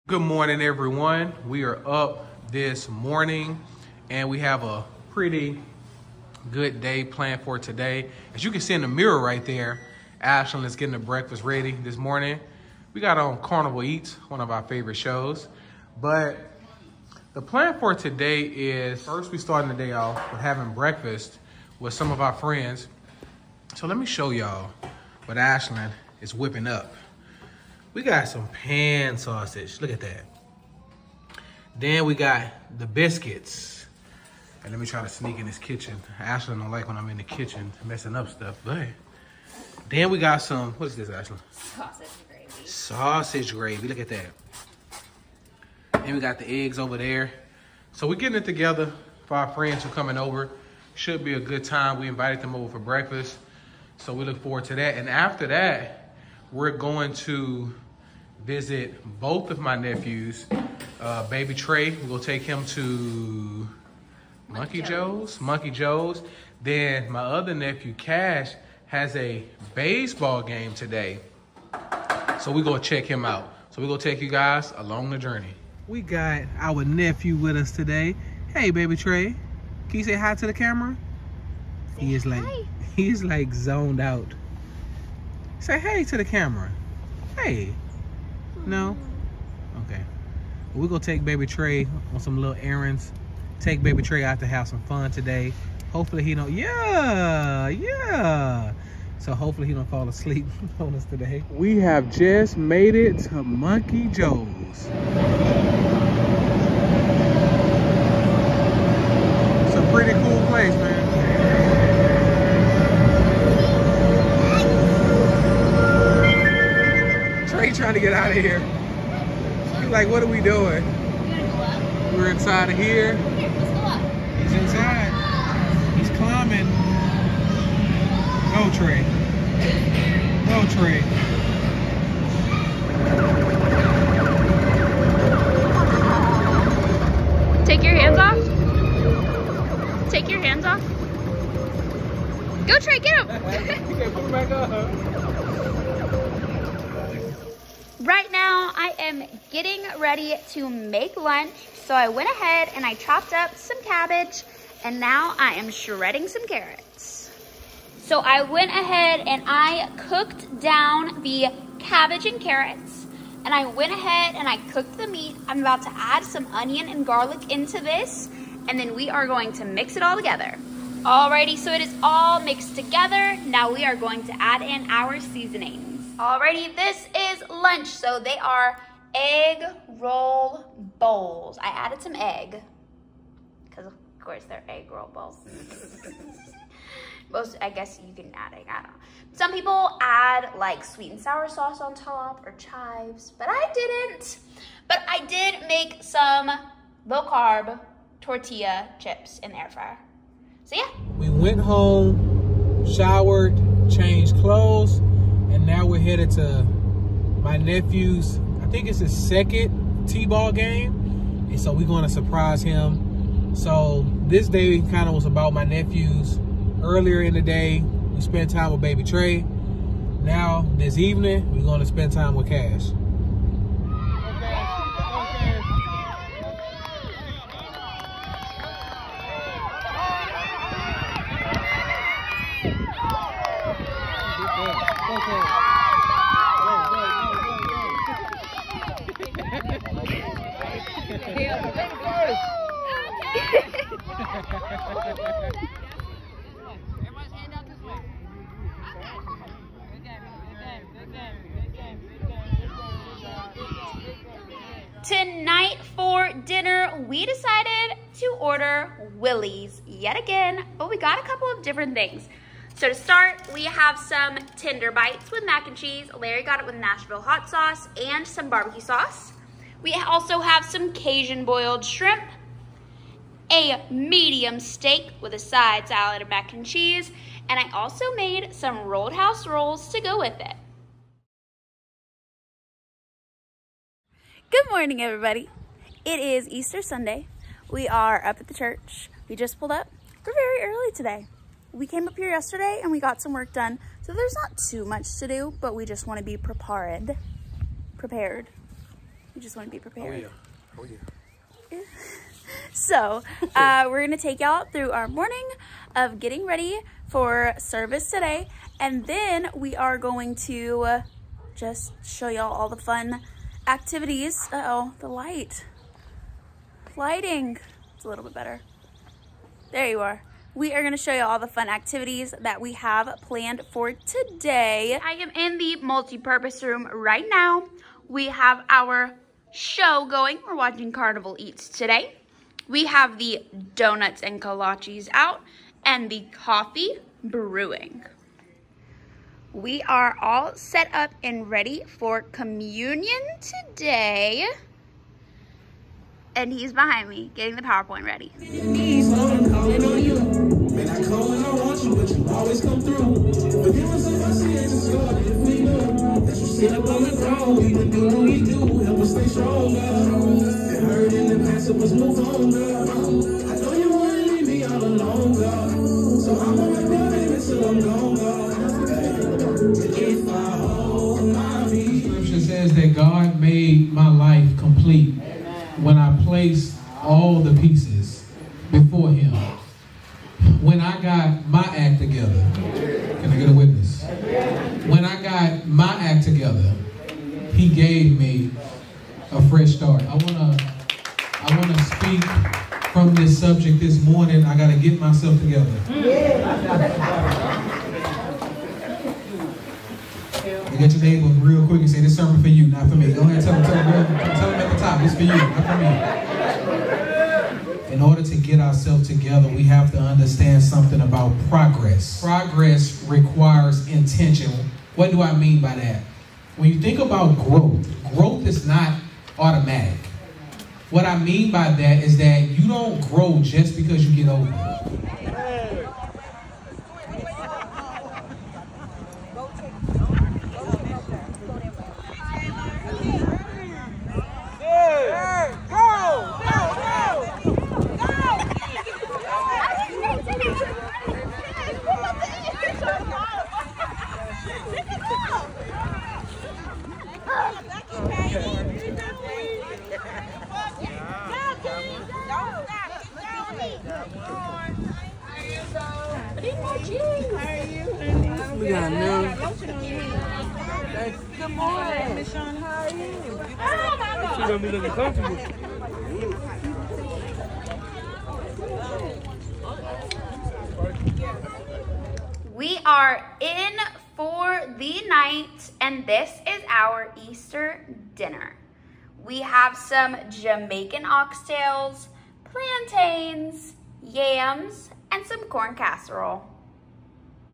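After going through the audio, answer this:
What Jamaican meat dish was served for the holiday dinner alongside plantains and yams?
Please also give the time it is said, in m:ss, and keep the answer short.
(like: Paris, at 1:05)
oxtails, at 8:01.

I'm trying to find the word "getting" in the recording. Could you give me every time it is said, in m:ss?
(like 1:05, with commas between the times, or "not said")
0:10, 0:48, 2:29, 5:06.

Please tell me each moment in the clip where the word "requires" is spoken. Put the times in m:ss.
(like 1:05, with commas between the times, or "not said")
6:53.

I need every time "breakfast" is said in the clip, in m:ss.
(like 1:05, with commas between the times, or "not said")
0:10, 0:20, 0:52.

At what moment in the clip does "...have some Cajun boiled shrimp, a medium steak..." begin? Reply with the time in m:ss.
4:30.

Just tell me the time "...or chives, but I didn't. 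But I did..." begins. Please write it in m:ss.
3:12.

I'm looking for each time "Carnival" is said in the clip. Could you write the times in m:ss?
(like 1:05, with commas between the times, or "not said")
0:13, 5:30.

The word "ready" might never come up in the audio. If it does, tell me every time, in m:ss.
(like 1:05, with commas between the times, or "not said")
0:11, 2:29, 5:06, 5:41.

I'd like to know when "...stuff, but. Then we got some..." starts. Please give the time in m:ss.
0:38.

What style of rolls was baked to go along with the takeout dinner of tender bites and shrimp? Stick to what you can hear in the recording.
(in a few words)
Roadhouse rolls.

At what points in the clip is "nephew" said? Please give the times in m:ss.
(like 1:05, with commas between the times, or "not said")
0:59, 1:07, 1:16, 3:27, 3:35.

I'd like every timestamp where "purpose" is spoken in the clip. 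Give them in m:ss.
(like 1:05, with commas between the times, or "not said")
5:25.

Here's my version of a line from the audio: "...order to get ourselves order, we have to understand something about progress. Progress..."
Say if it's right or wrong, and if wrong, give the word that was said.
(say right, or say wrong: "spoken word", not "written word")
wrong: "together", not "order".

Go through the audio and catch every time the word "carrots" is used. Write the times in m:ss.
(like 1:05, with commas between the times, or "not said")
2:36, 2:42.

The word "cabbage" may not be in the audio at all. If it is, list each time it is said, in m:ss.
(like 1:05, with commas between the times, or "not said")
2:33, 2:41.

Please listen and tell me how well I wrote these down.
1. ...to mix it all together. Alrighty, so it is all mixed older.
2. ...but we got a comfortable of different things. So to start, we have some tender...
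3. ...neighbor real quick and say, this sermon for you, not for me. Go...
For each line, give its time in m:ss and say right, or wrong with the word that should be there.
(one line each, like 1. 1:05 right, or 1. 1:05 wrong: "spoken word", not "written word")
1. 2:49 wrong: "together", not "older"
2. 4:20 wrong: "couple", not "comfortable"
3. 6:41 right.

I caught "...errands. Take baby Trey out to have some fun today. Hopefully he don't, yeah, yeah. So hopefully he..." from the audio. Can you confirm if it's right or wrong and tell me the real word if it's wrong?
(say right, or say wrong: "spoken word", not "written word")
right.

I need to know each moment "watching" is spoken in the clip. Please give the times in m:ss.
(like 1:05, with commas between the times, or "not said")
5:30.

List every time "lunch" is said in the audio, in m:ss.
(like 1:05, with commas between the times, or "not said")
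2:31, 2:57.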